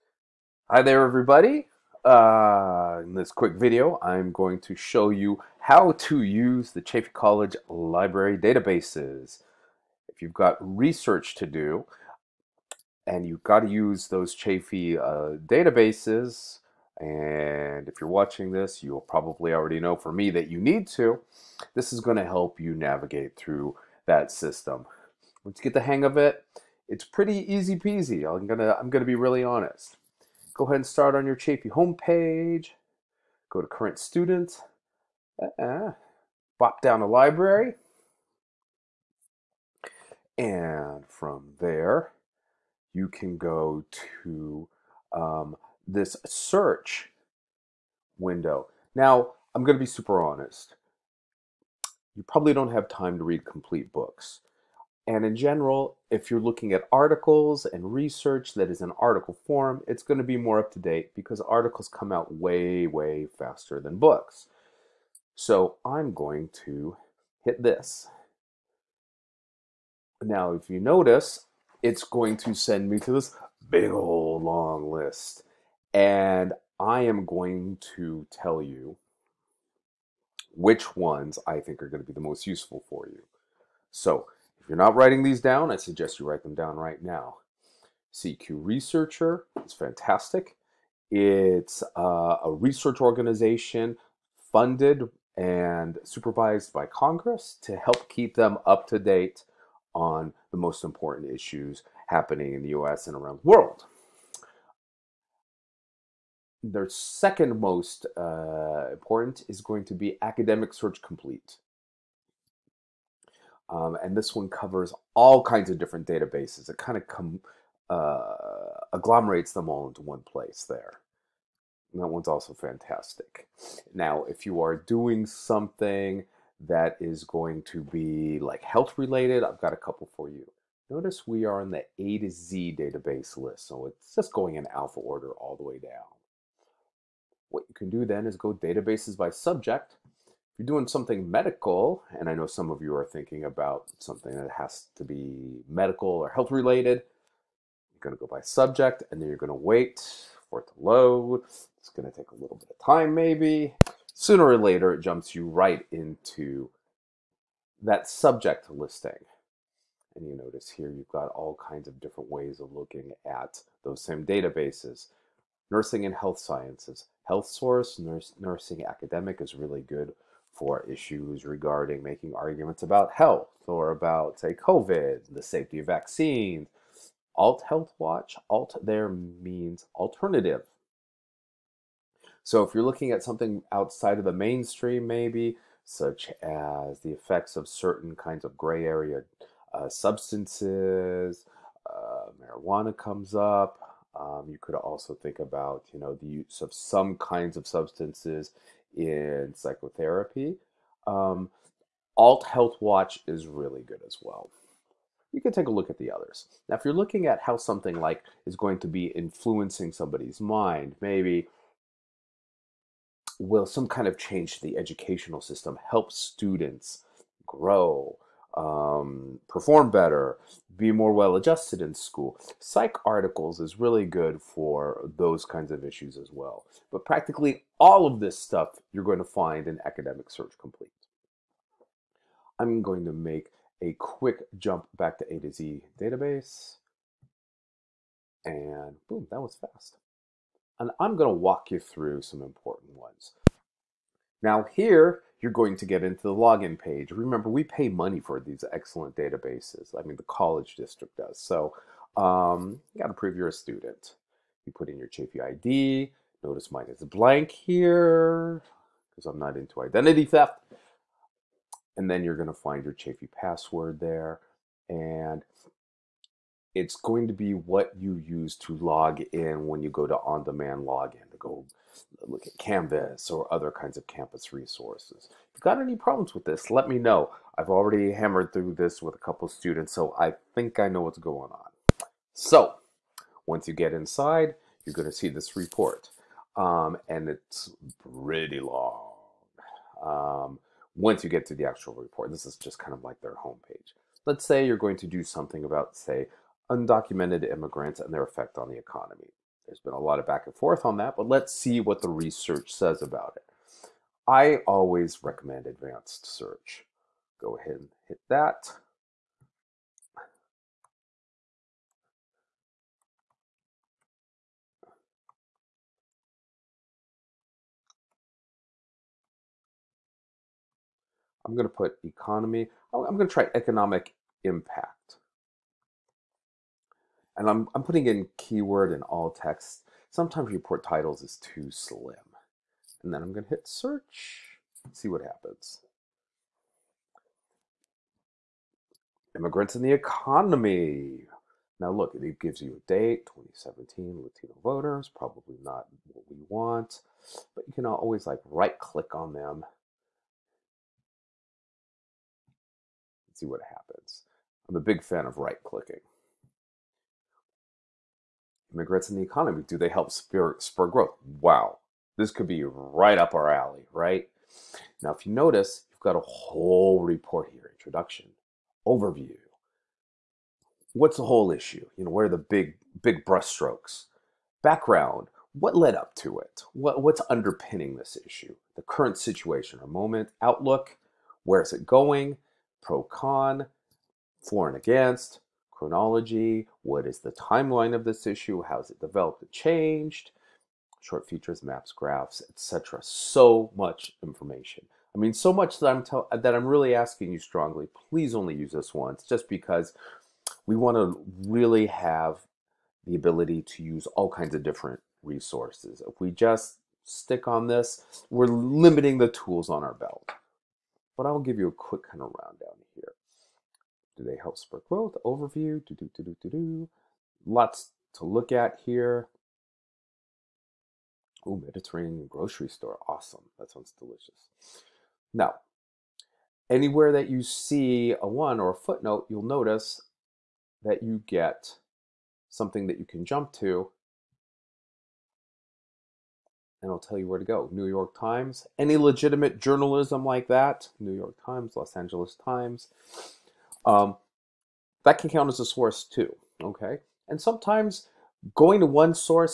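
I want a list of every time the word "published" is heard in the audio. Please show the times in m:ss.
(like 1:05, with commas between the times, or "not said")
not said.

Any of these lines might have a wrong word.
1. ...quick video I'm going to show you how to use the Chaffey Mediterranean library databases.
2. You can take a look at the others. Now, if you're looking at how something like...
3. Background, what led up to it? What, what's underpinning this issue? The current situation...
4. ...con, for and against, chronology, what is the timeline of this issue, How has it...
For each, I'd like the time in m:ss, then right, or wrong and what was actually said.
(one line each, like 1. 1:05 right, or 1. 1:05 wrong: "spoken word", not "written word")
1. 0:03 wrong: "College", not "Mediterranean"
2. 3:25 right
3. 6:14 right
4. 6:23 right.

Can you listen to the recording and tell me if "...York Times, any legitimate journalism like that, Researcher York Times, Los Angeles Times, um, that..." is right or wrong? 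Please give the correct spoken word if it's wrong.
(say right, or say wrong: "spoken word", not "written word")
wrong: "New", not "Researcher".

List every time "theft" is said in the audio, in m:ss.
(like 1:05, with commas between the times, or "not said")
4:20.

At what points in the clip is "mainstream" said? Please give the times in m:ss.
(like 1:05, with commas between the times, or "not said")
3:04.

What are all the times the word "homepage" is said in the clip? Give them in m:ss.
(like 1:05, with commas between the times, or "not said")
0:31, 4:53.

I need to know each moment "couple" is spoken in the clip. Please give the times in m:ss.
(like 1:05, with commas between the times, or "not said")
2:09, 4:39.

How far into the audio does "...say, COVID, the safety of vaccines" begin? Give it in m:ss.
2:54.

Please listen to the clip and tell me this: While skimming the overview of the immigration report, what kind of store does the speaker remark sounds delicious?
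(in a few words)
Mediterranean grocery store.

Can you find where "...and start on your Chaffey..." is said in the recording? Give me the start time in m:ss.
0:30.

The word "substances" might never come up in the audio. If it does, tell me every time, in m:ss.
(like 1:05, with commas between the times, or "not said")
3:09, 3:17.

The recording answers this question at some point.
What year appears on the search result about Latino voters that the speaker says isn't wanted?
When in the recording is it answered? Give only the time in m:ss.
5:43.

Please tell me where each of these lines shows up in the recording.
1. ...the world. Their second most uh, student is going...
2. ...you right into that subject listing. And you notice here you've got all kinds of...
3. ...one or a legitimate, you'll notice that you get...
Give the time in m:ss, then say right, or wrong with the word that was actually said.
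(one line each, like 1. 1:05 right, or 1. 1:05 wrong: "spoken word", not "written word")
1. 1:43 wrong: "important", not "student"
2. 2:35 right
3. 7:08 wrong: "footnote", not "legitimate".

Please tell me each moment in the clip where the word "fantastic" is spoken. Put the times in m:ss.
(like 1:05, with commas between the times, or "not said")
1:29, 2:02.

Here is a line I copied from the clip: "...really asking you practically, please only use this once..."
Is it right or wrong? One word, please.
wrong.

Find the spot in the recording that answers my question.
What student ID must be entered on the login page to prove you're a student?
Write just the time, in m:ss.
4:15.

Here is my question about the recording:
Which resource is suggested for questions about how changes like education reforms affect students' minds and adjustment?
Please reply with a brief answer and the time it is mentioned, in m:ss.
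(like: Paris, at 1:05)
Psych articles, at 3:42.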